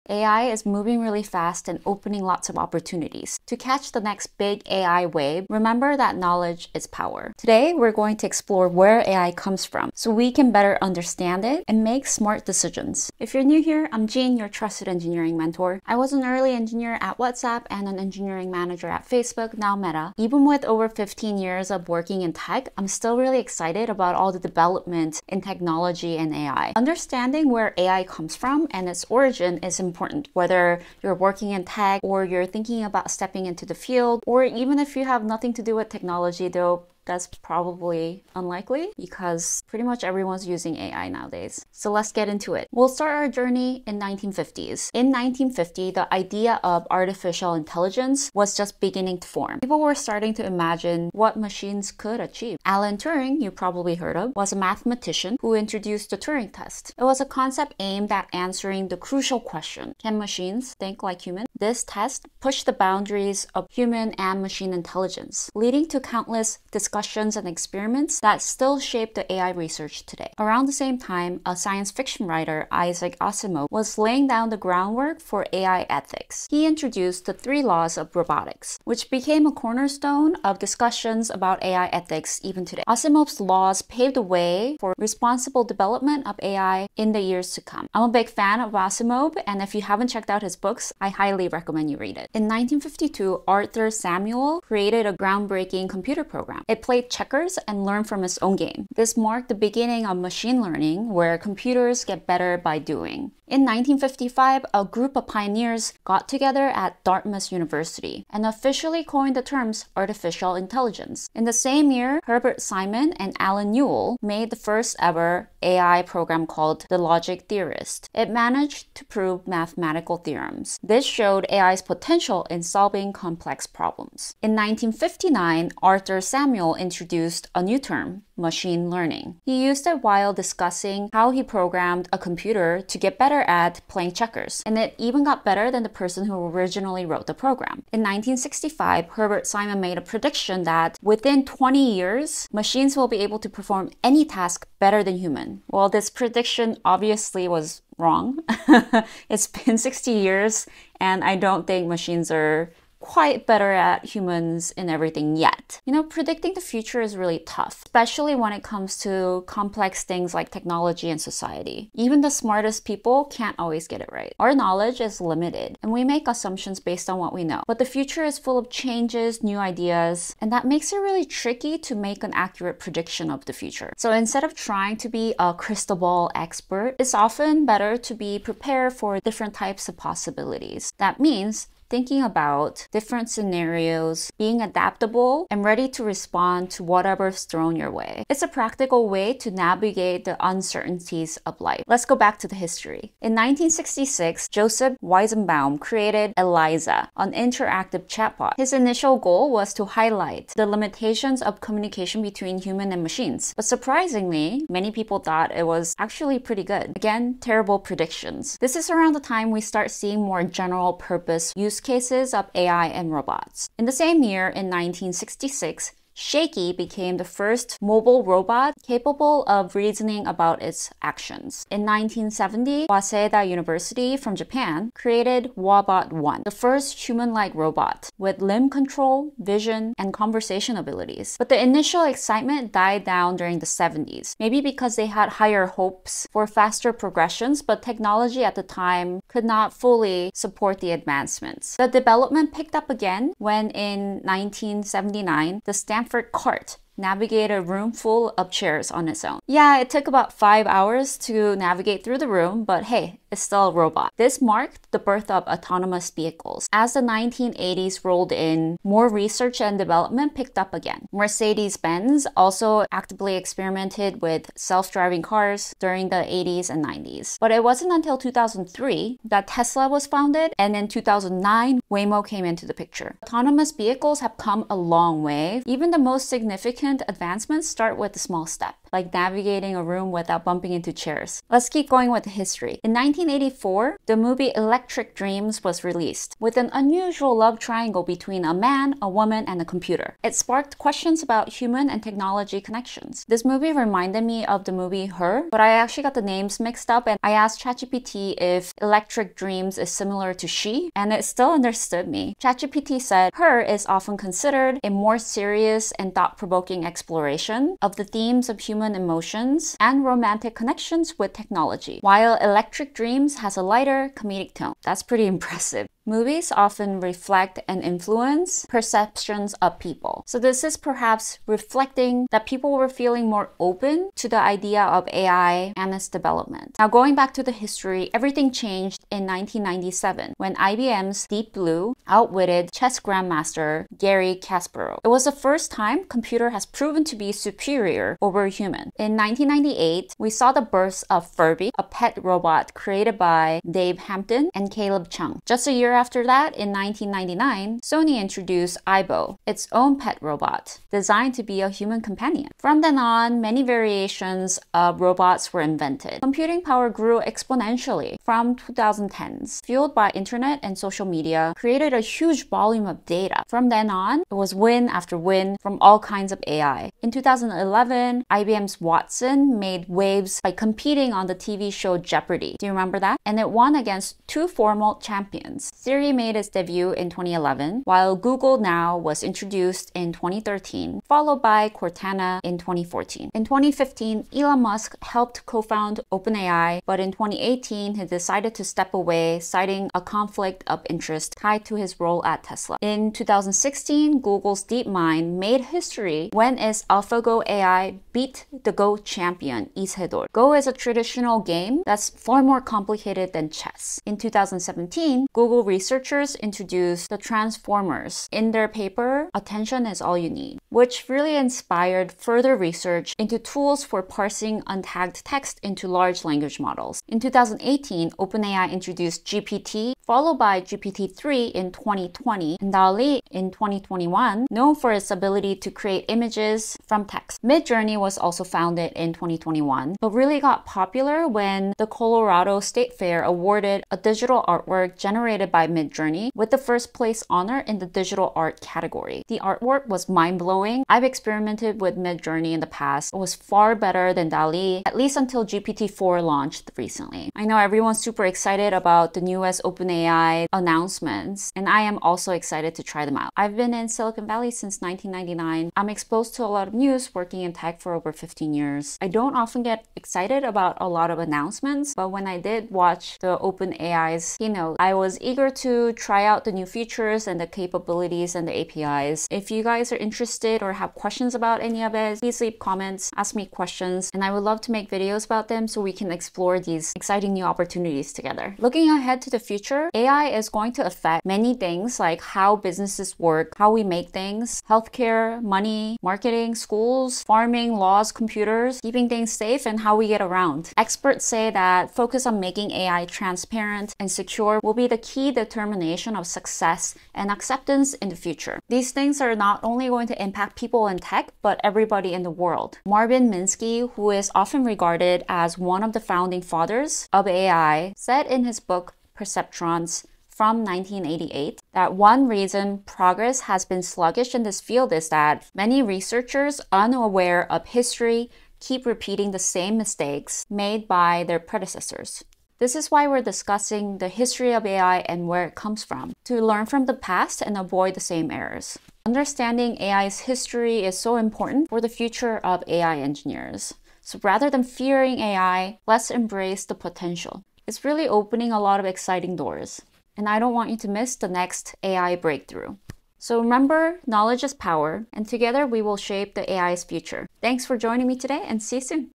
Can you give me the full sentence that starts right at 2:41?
Even the smartest people can't always get it right.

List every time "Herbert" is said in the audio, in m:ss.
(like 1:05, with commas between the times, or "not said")
1:52, 2:19.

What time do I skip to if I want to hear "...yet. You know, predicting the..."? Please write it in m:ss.
2:35.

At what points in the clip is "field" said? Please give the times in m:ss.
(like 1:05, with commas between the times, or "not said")
0:33, 8:34.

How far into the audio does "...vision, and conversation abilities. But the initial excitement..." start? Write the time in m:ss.
3:49.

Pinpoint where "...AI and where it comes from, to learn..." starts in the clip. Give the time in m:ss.
8:44.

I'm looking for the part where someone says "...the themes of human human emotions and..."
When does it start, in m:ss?
5:07.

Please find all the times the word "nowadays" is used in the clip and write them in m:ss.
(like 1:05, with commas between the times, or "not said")
0:41.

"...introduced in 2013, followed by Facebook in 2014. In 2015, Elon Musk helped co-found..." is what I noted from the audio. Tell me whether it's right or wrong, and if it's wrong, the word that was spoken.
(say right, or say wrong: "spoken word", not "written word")
wrong: "Cortana", not "Facebook".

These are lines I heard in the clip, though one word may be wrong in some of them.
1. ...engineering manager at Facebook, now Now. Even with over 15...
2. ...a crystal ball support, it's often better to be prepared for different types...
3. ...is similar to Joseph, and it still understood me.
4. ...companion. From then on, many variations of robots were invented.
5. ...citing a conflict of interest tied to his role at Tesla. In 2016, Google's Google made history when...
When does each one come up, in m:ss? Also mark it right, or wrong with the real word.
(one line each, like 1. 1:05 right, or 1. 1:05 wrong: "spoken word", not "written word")
1. 0:17 wrong: "Meta", not "Now"
2. 2:55 wrong: "expert", not "support"
3. 4:59 wrong: "She", not "Joseph"
4. 5:51 right
5. 6:29 wrong: "DeepMind", not "Google".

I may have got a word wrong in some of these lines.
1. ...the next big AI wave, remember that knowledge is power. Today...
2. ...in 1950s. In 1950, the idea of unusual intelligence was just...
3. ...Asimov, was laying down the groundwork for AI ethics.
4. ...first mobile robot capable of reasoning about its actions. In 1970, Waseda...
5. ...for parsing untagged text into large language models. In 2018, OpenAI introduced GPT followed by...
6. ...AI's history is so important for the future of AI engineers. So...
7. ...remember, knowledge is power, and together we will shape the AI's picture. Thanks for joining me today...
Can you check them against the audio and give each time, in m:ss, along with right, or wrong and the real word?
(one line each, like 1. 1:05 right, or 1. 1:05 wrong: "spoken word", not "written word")
1. 0:03 right
2. 0:43 wrong: "artificial", not "unusual"
3. 1:13 right
4. 3:37 right
5. 6:53 right
6. 8:49 right
7. 9:03 wrong: "future", not "picture".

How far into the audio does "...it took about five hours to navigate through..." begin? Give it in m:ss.
4:09.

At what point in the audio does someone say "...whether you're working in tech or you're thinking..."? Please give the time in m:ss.
0:30.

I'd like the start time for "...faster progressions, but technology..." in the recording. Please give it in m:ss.
3:56.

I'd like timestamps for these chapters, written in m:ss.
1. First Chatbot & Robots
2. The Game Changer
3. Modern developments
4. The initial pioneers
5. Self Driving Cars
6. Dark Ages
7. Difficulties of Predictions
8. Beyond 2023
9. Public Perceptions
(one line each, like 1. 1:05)
1. 3:13
2. 6:43
3. 5:28
4. 0:44
5. 4:03
6. 3:51
7. 2:17
8. 7:58
9. 4:42.